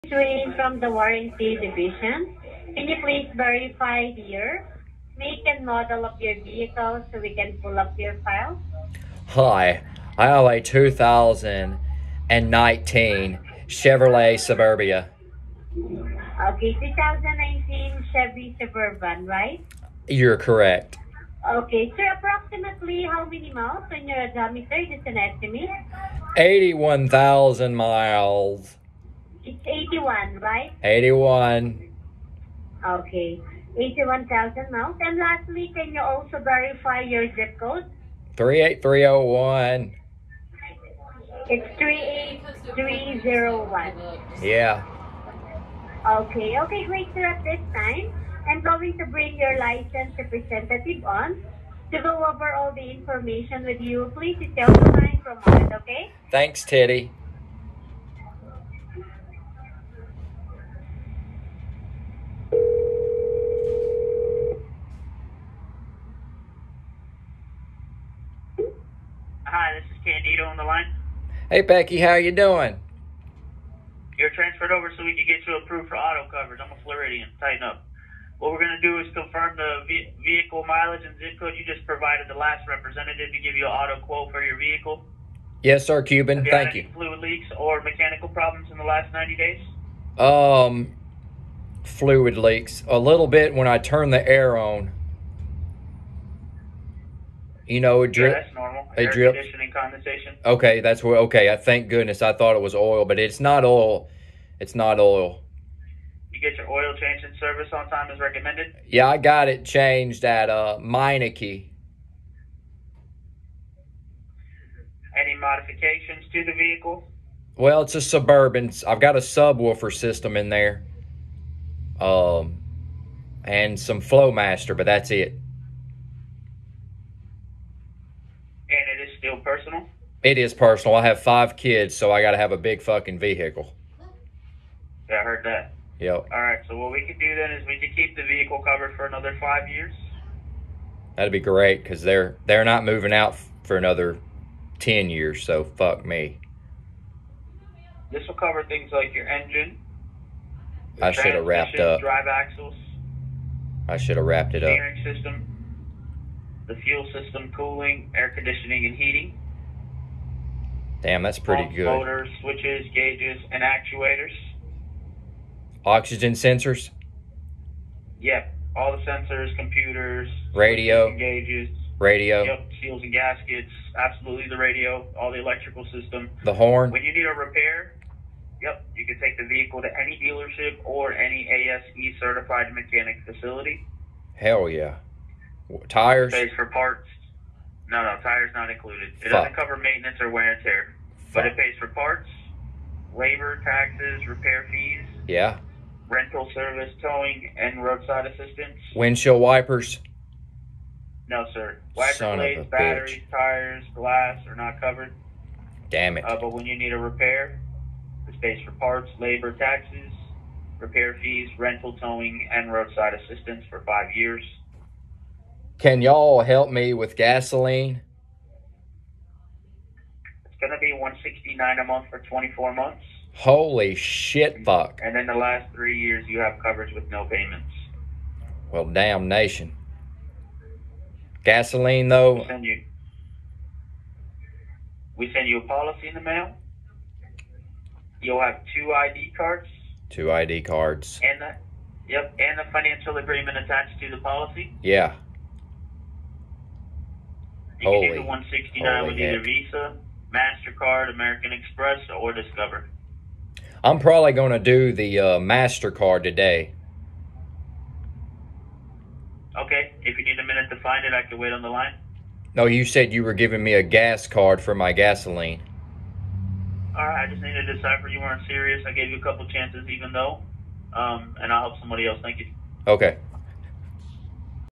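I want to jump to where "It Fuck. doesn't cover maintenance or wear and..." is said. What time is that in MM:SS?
03:09.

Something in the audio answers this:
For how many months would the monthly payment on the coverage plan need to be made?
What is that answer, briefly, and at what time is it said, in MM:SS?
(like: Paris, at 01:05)
24, at 03:42.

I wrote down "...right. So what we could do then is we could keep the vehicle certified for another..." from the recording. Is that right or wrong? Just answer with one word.
wrong.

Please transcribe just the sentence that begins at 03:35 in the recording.
Can y'all help me with gasoline?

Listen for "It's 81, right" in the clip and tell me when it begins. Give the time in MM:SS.
00:29.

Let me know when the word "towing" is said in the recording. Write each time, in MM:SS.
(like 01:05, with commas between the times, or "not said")
03:17, 03:31.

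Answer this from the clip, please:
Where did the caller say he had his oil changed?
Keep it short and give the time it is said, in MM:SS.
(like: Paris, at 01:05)
Meineke, at 01:50.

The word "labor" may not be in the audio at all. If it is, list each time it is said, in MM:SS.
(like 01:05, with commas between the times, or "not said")
03:13, 03:29.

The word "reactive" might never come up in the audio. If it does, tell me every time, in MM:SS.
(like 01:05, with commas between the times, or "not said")
not said.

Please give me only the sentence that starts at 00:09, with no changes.
Hi, I have a 2019 Chevrolet Suburbia.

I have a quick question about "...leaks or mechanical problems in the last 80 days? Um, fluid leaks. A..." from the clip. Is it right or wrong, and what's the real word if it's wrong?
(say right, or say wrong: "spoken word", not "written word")
wrong: "90", not "80".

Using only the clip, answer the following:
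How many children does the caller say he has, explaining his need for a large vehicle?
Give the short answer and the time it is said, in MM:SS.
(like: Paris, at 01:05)
5, at 02:11.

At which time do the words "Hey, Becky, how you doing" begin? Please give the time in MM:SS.
01:11.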